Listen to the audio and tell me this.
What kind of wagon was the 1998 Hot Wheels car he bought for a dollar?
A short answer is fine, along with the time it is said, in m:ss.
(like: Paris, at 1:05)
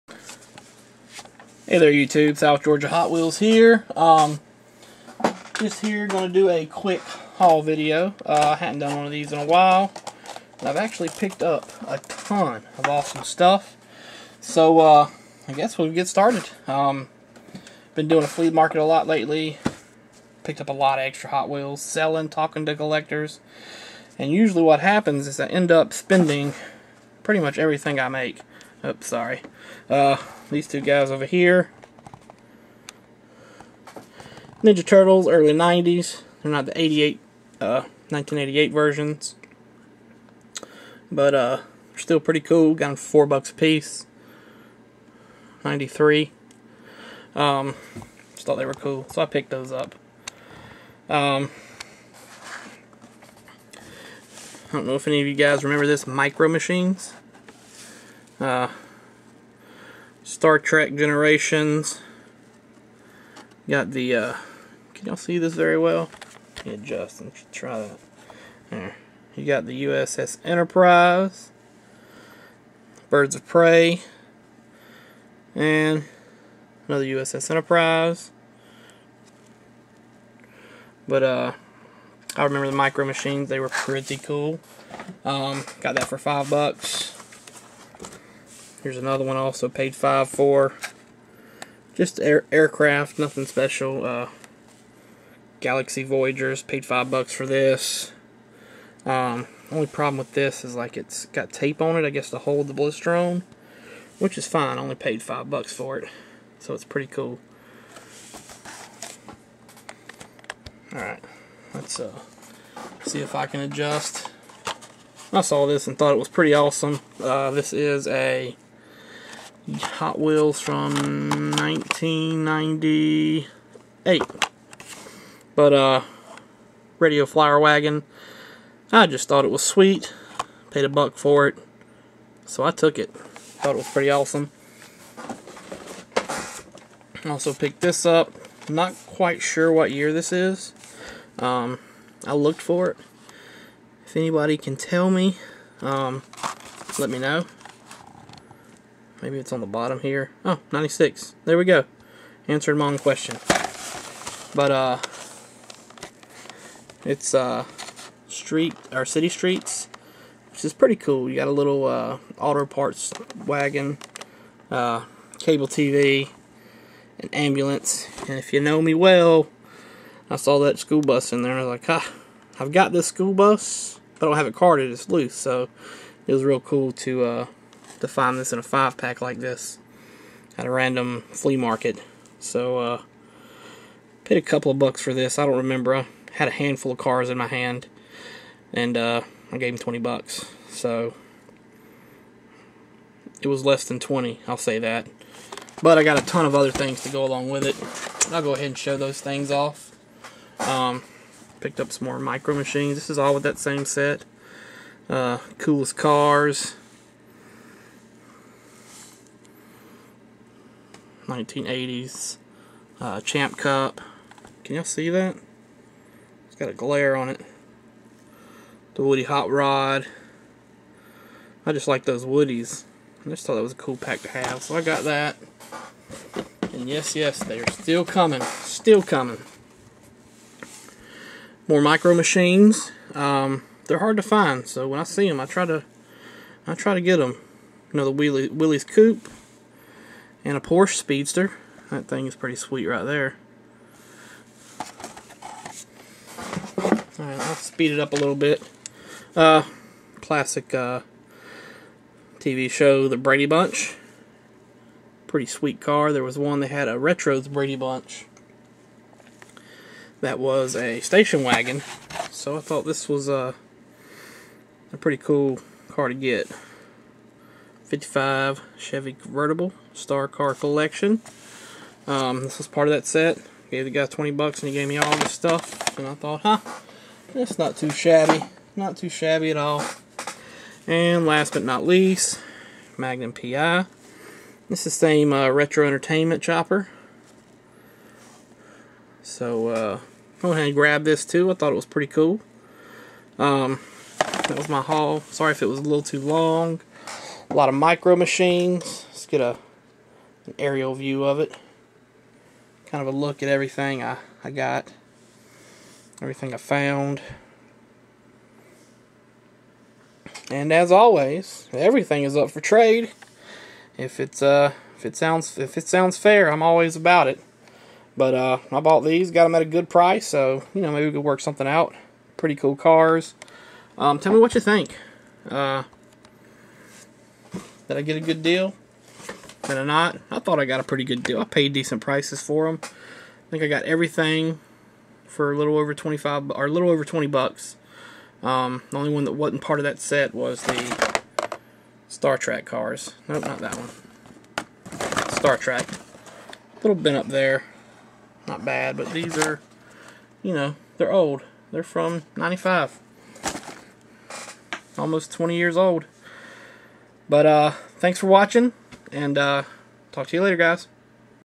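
Radio Flyer, at 2:06.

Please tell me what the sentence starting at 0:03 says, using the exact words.
Um, just here going to do a quick haul video.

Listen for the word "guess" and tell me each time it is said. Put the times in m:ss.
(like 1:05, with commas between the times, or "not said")
0:15, 1:42.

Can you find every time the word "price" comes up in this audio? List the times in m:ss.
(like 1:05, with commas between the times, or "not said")
5:19, 5:32.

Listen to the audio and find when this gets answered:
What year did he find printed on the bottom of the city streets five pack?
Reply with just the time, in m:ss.
2:30.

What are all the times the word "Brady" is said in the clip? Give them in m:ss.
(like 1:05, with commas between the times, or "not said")
4:13, 4:17.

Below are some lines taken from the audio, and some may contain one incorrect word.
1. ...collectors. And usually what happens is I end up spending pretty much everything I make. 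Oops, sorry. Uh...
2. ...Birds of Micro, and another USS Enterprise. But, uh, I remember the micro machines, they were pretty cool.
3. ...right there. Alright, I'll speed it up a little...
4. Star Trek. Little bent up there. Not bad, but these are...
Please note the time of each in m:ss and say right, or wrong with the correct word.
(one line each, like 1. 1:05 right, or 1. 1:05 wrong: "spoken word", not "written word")
1. 0:22 right
2. 1:13 wrong: "Prey", not "Micro"
3. 4:02 right
4. 5:45 right.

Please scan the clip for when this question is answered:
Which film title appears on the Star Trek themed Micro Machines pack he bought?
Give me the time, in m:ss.
1:00.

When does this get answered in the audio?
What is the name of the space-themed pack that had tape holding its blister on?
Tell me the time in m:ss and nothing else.
1:35.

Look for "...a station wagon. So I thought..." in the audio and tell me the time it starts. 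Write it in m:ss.
4:20.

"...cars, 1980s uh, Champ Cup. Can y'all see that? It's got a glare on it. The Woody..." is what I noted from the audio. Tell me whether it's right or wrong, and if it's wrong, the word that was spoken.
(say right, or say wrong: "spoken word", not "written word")
right.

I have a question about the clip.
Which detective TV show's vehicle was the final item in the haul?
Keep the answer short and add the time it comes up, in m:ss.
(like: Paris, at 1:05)
Magnum PI, at 4:42.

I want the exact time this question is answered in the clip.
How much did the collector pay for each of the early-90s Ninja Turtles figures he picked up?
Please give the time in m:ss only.
0:42.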